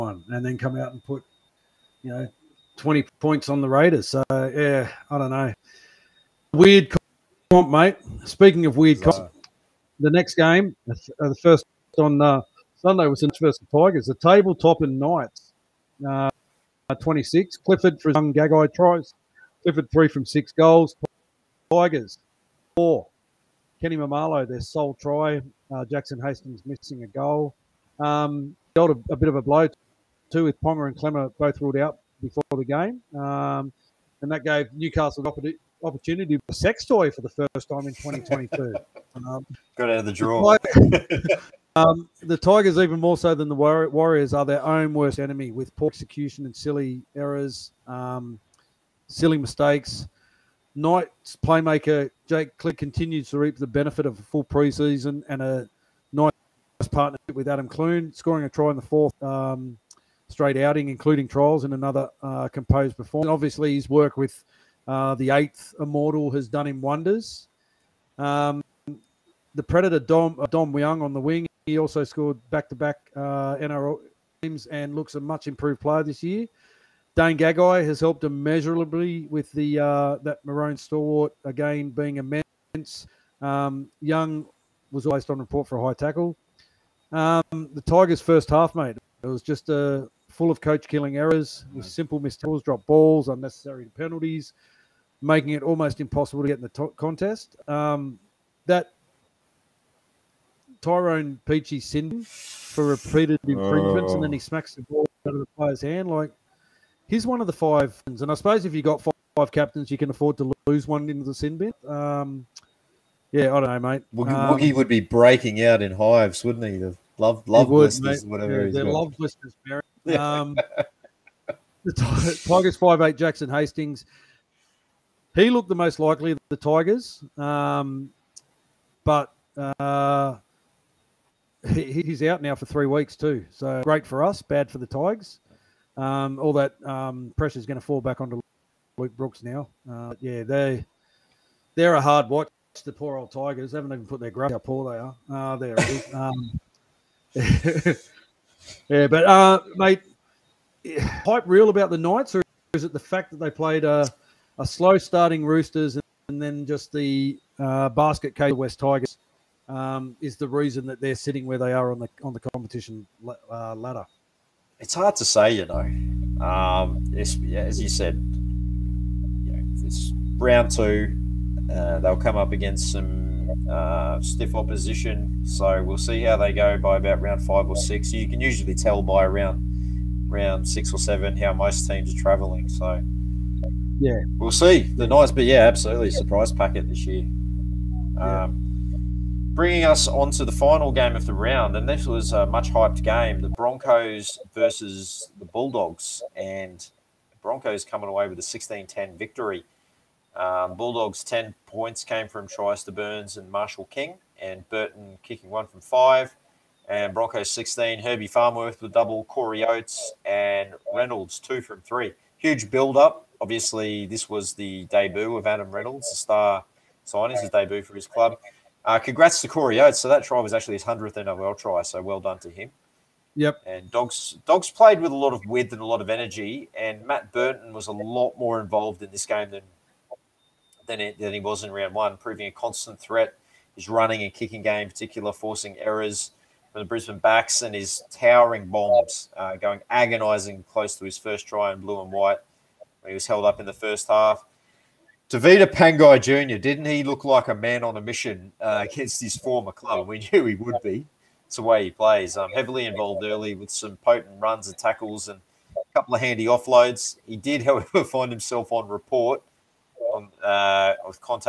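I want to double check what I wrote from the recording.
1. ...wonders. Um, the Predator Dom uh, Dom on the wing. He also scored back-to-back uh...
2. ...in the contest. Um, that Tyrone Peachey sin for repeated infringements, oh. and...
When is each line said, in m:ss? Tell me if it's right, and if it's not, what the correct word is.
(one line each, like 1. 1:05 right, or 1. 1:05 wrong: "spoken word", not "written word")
1. 1:06 right
2. 1:36 right.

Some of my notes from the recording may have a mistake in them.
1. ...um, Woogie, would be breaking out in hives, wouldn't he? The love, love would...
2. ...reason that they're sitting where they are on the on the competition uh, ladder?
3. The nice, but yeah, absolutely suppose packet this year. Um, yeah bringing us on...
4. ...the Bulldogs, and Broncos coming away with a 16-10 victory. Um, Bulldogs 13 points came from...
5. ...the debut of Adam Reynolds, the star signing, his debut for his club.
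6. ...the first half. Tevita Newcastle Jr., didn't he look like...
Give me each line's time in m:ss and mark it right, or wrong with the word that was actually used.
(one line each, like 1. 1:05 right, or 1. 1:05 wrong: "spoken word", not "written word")
1. 1:54 right
2. 2:40 right
3. 3:04 wrong: "surprise", not "suppose"
4. 3:15 wrong: "10", not "13"
5. 3:34 right
6. 4:03 wrong: "Pangai", not "Newcastle".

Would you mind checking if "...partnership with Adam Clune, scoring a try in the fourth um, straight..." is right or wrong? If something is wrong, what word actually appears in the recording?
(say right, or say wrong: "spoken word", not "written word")
right.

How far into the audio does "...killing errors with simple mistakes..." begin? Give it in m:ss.
1:30.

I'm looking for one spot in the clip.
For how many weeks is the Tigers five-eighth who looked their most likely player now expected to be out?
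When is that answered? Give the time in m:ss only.
2:12.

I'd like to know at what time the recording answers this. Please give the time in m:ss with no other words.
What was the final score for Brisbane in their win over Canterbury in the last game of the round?
3:27.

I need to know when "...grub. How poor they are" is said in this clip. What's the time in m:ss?
2:24.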